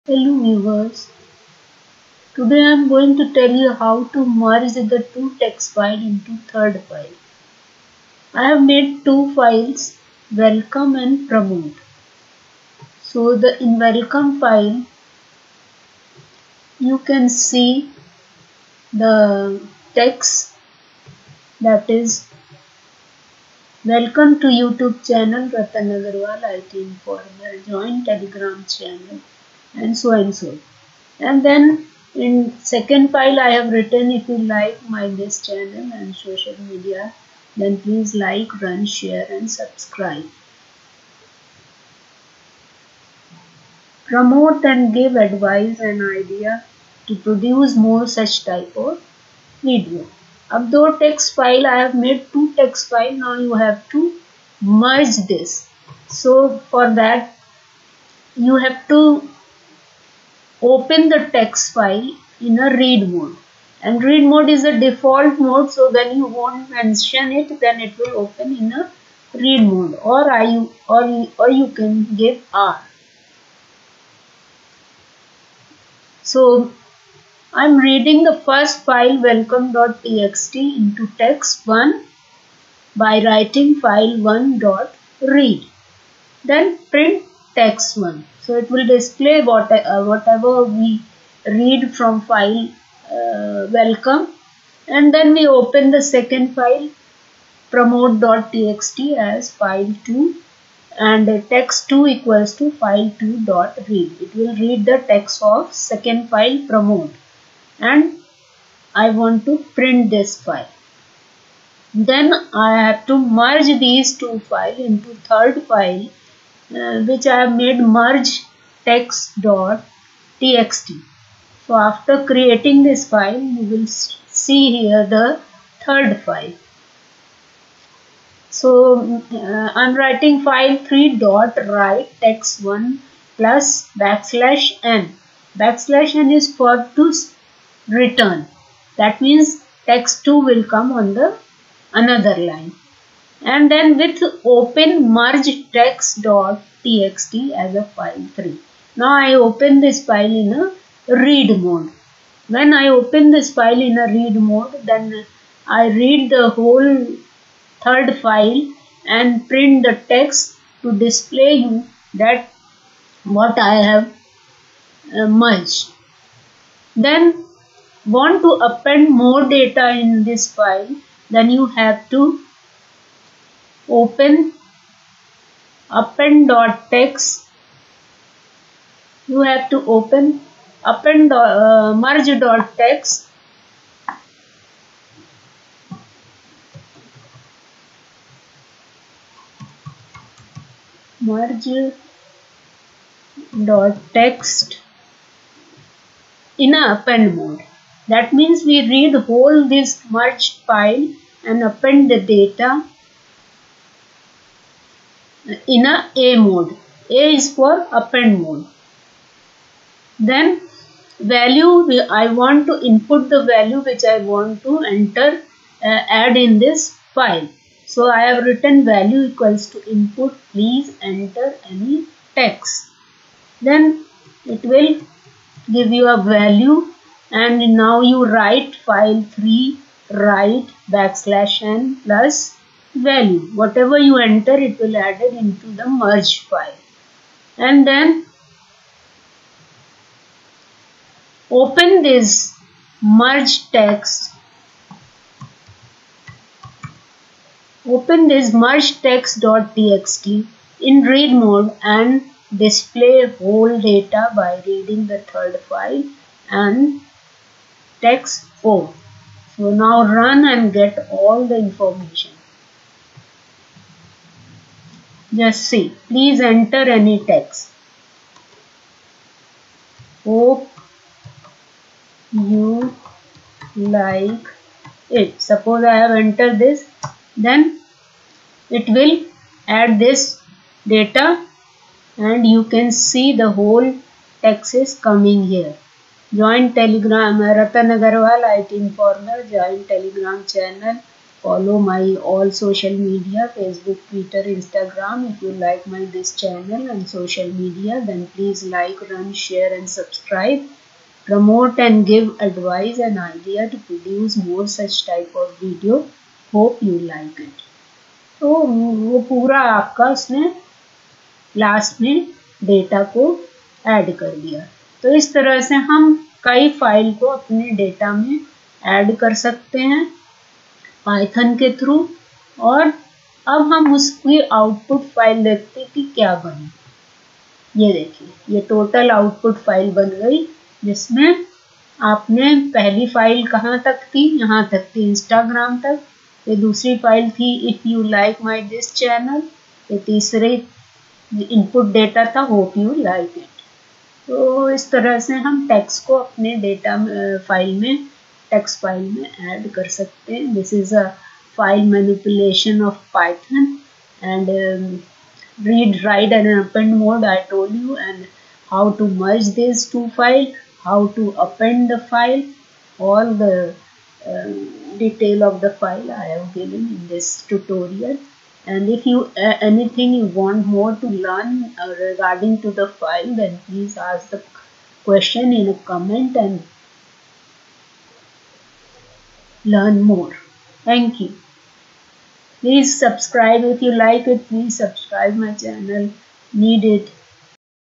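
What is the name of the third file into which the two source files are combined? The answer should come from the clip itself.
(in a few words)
merge txt.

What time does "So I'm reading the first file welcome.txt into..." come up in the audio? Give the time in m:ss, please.
1:16.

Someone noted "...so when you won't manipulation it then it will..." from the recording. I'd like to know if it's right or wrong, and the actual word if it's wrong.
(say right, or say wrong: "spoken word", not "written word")
wrong: "mention", not "manipulation".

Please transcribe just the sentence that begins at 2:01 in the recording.
So after creating this file, you will see here the third file.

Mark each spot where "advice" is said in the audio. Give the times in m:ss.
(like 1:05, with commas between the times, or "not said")
0:45, 5:02.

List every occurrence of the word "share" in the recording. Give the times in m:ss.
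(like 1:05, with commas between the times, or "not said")
0:38, 4:59.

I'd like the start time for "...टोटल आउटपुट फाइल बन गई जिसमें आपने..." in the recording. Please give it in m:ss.
5:28.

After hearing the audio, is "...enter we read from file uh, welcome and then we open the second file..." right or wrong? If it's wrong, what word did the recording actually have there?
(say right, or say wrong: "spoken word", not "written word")
wrong: "whatever", not "enter".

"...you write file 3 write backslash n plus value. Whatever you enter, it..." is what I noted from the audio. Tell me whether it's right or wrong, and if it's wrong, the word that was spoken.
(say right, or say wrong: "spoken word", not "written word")
right.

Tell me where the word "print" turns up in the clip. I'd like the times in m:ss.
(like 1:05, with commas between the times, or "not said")
1:26, 1:49, 2:39.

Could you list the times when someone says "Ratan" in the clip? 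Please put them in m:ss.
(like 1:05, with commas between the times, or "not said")
0:25, 4:47.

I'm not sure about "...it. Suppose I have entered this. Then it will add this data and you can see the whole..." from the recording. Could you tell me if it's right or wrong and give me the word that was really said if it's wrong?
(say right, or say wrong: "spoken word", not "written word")
right.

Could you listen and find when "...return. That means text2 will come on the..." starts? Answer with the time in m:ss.
2:17.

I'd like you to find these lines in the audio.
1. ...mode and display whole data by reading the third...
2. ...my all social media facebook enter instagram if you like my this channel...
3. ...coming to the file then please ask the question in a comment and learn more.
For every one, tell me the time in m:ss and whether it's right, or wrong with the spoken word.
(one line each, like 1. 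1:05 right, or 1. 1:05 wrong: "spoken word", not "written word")
1. 4:11 right
2. 4:51 wrong: "twitter", not "enter"
3. 6:12 wrong: "regarding", not "coming".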